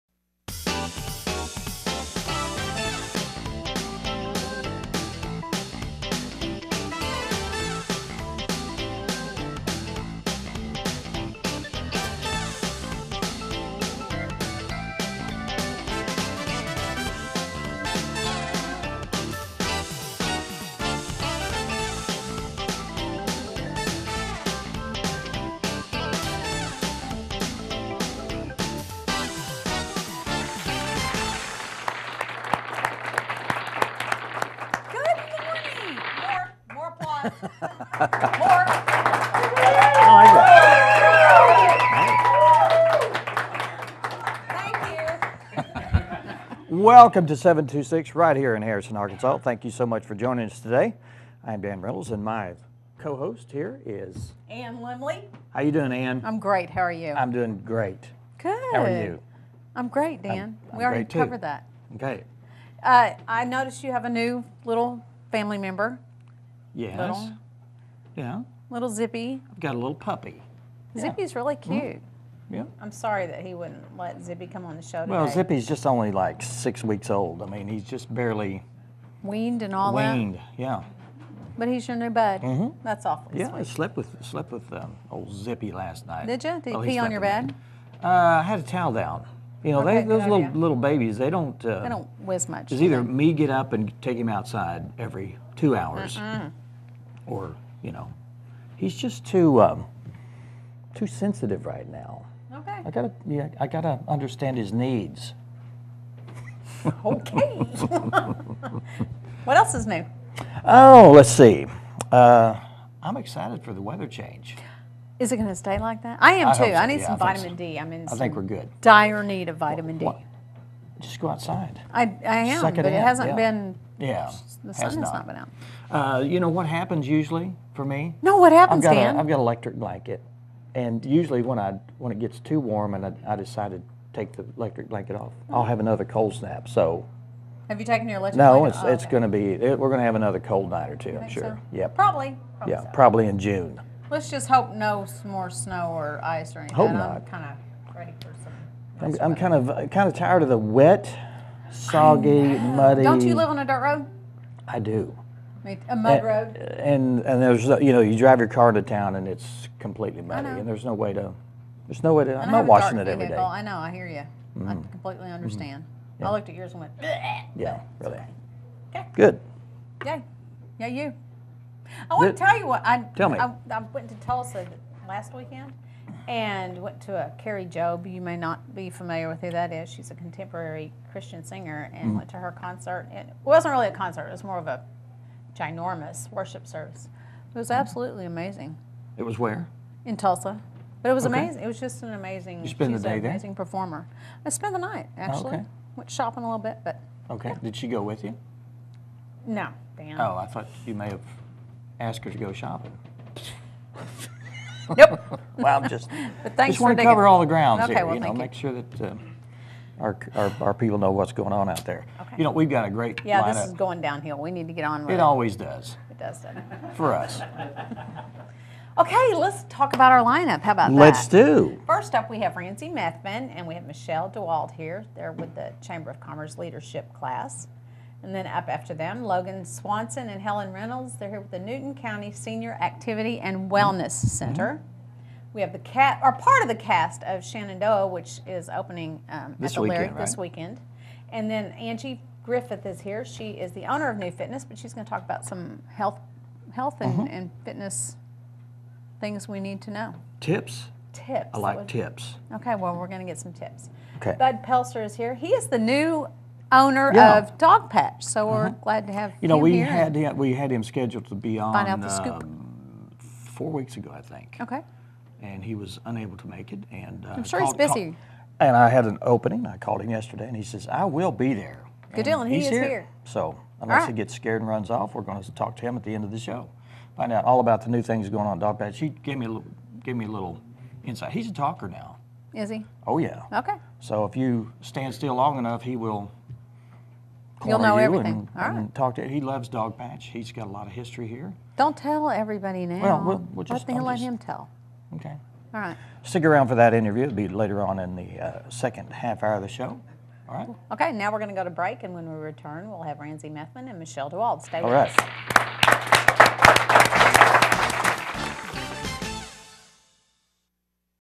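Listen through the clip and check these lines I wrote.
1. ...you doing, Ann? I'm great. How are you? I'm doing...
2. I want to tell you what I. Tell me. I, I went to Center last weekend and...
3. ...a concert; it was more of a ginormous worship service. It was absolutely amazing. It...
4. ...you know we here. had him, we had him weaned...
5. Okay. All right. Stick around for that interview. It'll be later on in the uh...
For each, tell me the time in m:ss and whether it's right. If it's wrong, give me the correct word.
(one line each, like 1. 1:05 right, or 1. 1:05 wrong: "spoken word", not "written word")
1. 0:55 right
2. 2:52 wrong: "Tulsa", not "Center"
3. 3:03 right
4. 4:19 wrong: "scheduled", not "weaned"
5. 4:55 right.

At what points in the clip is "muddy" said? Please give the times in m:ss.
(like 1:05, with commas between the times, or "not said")
2:32, 2:40.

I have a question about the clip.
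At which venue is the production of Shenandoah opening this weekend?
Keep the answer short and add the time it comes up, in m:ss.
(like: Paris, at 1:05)
the Lyric, at 3:59.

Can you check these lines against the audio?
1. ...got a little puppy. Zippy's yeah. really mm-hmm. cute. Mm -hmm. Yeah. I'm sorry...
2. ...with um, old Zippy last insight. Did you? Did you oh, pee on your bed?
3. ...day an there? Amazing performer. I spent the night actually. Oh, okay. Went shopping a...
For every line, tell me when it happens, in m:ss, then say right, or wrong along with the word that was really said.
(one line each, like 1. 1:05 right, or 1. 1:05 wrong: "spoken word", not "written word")
1. 1:09 right
2. 1:24 wrong: "night", not "insight"
3. 3:12 right.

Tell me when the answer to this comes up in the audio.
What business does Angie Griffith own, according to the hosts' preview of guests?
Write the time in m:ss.
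4:04.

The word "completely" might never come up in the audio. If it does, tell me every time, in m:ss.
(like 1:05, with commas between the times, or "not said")
2:39, 2:44.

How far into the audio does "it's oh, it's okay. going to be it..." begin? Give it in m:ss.
2:18.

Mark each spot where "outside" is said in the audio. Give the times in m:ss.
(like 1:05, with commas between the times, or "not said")
1:34, 2:01.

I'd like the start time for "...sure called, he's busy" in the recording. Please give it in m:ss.
4:27.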